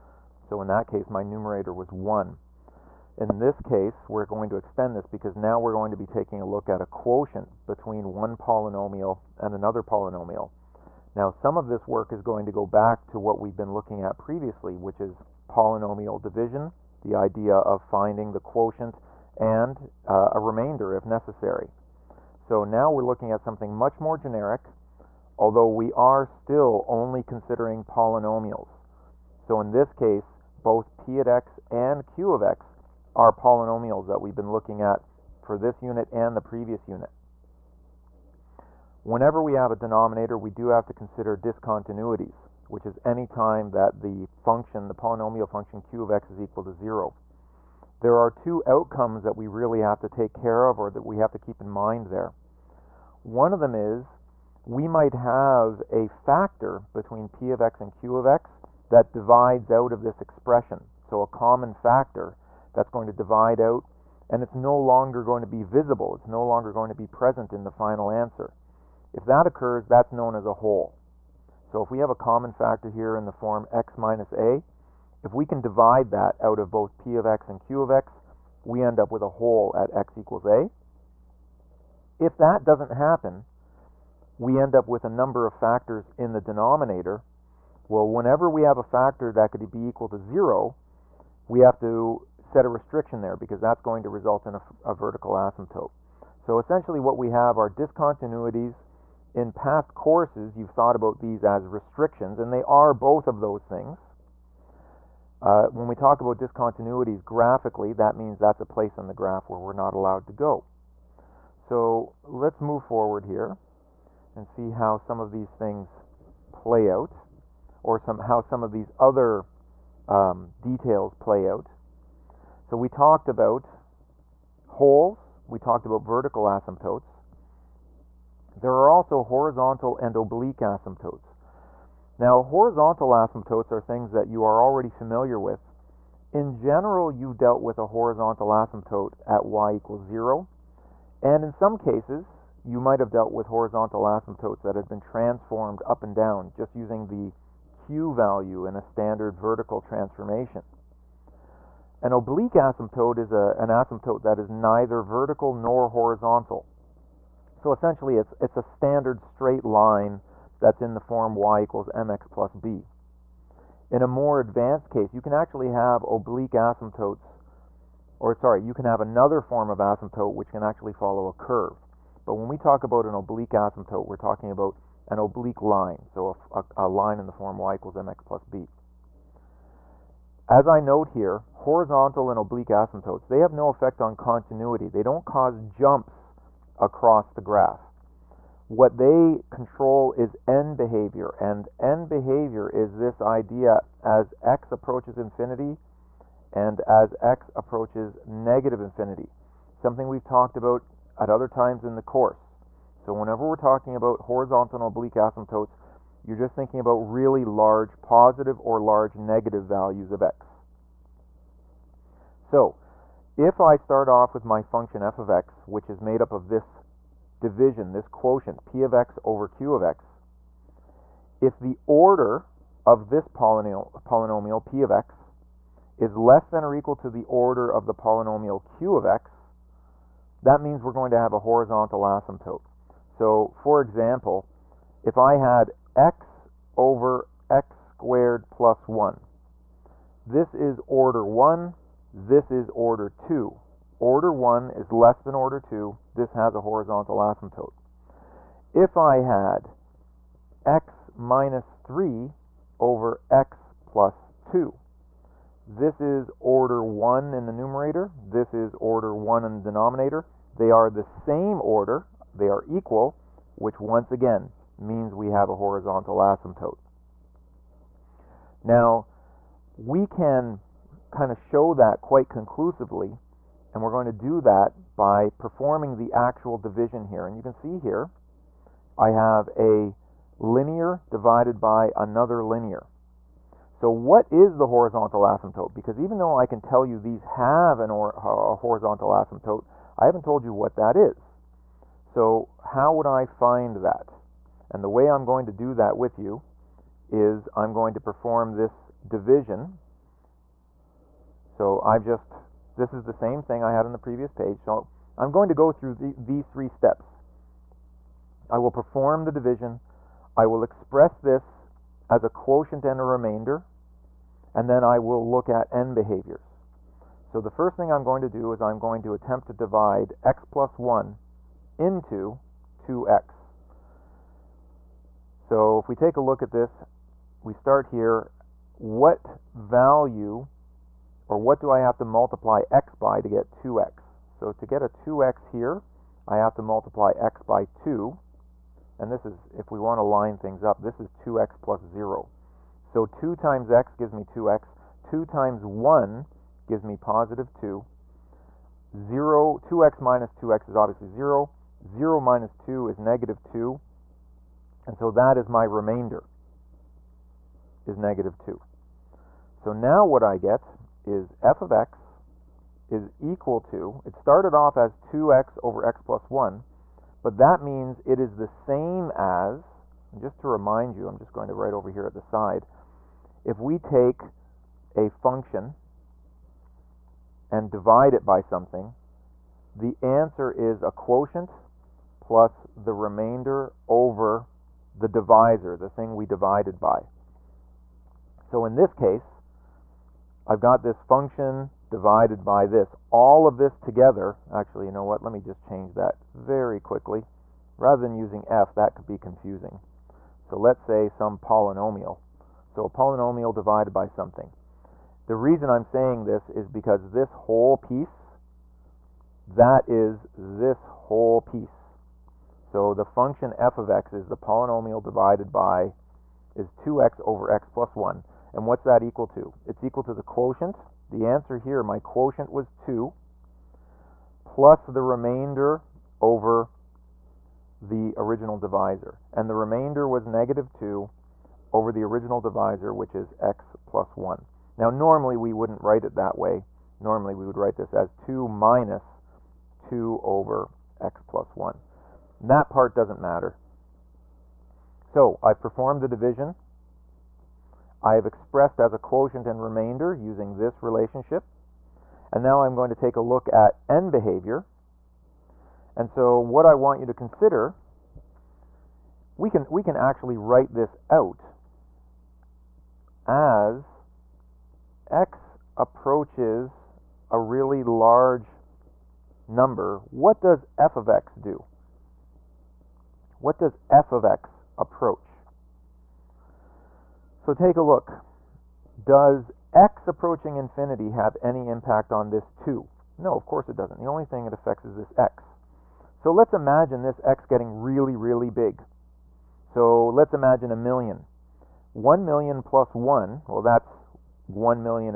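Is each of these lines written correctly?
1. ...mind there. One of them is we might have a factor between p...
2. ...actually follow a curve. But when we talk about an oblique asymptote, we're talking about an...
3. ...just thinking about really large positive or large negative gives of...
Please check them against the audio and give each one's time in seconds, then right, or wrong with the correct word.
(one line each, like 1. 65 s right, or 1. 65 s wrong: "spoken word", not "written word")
1. 51 s right
2. 170 s right
3. 206 s wrong: "values", not "gives".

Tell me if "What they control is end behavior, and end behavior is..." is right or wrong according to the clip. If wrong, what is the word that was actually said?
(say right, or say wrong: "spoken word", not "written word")
right.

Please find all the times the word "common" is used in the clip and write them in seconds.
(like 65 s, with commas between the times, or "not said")
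61 s, 72 s.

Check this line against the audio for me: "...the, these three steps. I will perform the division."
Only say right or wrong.
right.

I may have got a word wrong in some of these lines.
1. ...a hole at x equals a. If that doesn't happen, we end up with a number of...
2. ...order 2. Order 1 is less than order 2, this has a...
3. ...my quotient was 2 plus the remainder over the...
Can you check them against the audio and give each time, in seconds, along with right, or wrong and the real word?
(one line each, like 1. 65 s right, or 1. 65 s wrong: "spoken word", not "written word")
1. 79 s right
2. 242 s right
3. 421 s right.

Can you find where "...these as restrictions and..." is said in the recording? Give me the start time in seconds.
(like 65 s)
101 s.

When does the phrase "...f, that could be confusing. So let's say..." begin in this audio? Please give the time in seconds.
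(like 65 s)
398 s.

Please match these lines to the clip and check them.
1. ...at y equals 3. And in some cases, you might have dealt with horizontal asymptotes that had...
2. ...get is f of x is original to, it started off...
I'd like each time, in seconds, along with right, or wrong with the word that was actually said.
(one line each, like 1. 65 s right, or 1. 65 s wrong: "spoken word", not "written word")
1. 139 s wrong: "0", not "3"
2. 360 s wrong: "equal", not "original".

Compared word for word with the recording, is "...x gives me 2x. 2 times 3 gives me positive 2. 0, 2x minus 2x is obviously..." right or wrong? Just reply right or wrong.
wrong.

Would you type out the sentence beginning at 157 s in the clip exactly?
So essentially it's, it's a standard straight line that's in the form y equals mx plus b.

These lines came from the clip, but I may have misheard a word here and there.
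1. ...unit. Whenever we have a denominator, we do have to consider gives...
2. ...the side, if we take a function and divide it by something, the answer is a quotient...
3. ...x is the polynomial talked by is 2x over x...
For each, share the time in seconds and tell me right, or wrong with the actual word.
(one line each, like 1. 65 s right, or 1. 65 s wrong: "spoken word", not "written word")
1. 36 s wrong: "discontinuities", not "gives"
2. 372 s right
3. 413 s wrong: "divided", not "talked".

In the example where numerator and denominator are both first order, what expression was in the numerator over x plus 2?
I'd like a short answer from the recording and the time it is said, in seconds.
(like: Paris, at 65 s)
x - 3, at 250 s.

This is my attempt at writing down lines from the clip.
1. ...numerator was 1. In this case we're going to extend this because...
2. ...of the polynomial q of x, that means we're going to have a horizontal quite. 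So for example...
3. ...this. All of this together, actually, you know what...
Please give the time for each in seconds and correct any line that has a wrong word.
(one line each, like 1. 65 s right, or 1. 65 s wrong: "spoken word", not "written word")
1. 1 s right
2. 227 s wrong: "asymptote", not "quite"
3. 392 s right.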